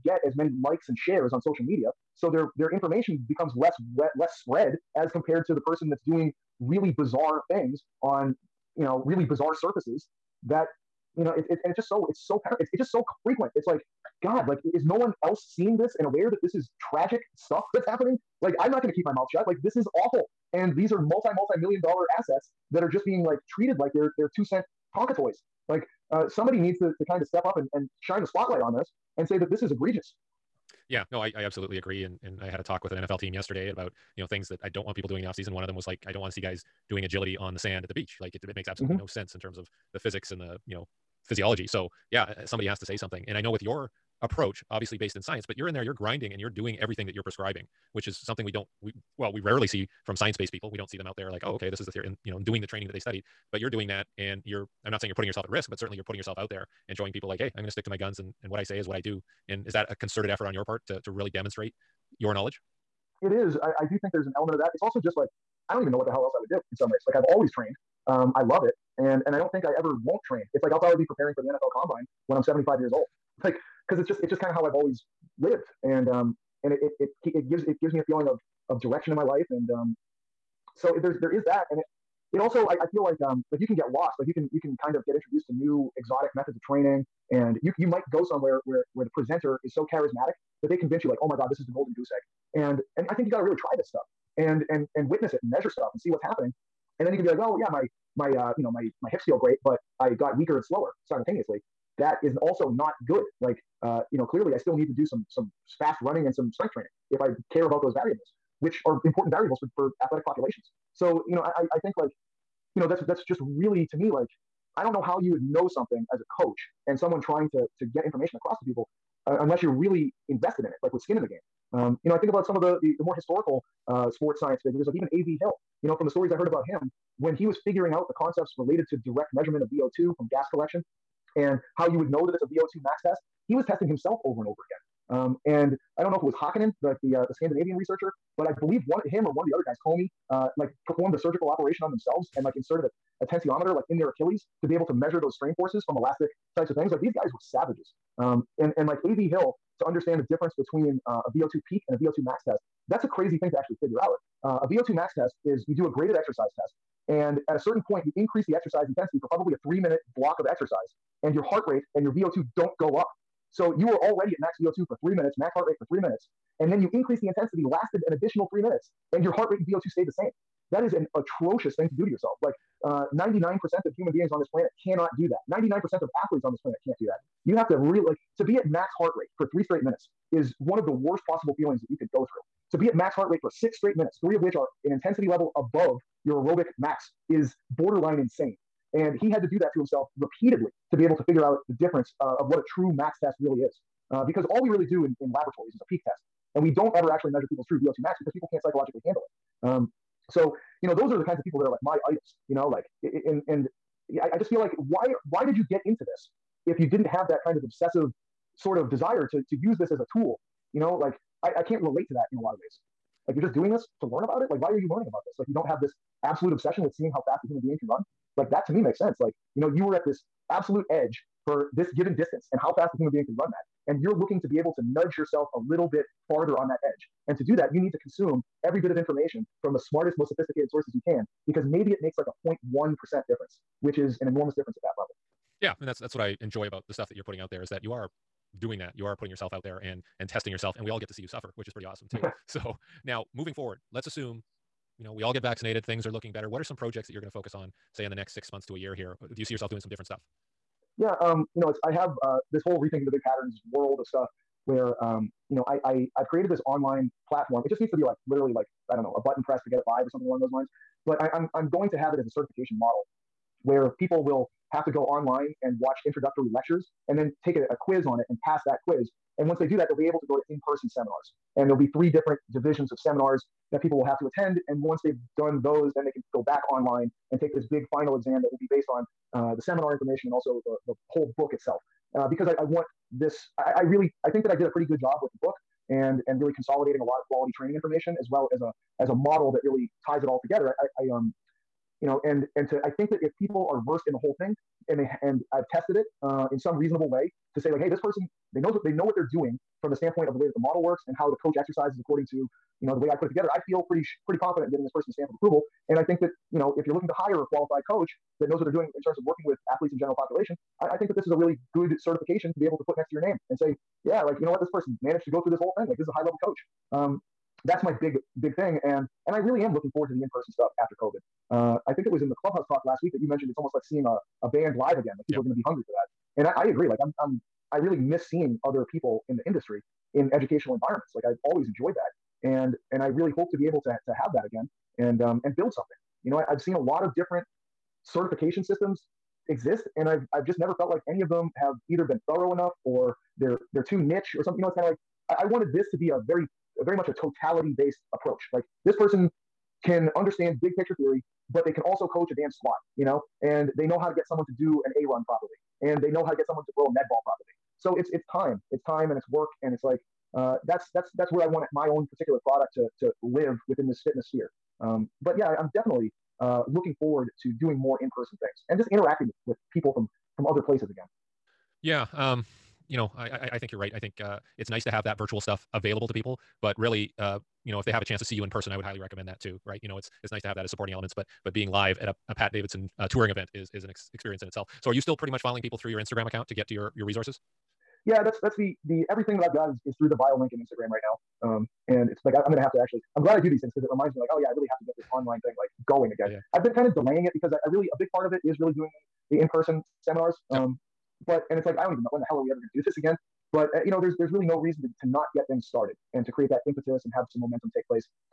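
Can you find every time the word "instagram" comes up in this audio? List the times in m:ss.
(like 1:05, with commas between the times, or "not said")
6:25, 6:30.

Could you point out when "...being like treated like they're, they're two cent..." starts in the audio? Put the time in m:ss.
0:23.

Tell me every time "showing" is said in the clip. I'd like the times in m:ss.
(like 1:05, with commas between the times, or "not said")
0:56.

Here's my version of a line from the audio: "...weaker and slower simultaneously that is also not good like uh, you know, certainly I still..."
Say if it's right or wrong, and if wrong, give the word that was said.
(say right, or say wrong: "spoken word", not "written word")
wrong: "clearly", not "certainly".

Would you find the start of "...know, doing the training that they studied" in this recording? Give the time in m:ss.
0:52.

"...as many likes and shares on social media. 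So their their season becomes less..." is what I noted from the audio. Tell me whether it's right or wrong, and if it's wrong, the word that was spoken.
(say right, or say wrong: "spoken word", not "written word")
wrong: "information", not "season".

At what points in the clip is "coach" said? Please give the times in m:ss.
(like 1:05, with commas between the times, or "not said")
1:56, 5:01, 5:07, 5:16, 5:52.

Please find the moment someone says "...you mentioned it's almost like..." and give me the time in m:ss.
5:23.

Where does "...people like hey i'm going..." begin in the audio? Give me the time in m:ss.
0:57.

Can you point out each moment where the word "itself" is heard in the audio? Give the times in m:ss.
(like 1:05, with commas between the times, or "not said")
4:41, 6:24.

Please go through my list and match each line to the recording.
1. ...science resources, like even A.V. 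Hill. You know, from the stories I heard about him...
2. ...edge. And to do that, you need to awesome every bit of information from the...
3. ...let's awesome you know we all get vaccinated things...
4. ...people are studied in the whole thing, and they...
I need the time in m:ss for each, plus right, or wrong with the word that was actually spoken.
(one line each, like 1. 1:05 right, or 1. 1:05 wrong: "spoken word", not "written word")
1. 2:04 wrong: "figures", not "resources"
2. 3:46 wrong: "consume", not "awesome"
3. 4:03 wrong: "assume", not "awesome"
4. 4:53 wrong: "versed", not "studied".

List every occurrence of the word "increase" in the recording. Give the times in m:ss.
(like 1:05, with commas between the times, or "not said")
2:38, 2:46.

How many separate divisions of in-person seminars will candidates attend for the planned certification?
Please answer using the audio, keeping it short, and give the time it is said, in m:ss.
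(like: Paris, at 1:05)
3, at 4:31.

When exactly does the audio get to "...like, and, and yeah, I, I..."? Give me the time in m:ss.
3:22.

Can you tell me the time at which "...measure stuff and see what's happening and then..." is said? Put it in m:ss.
1:35.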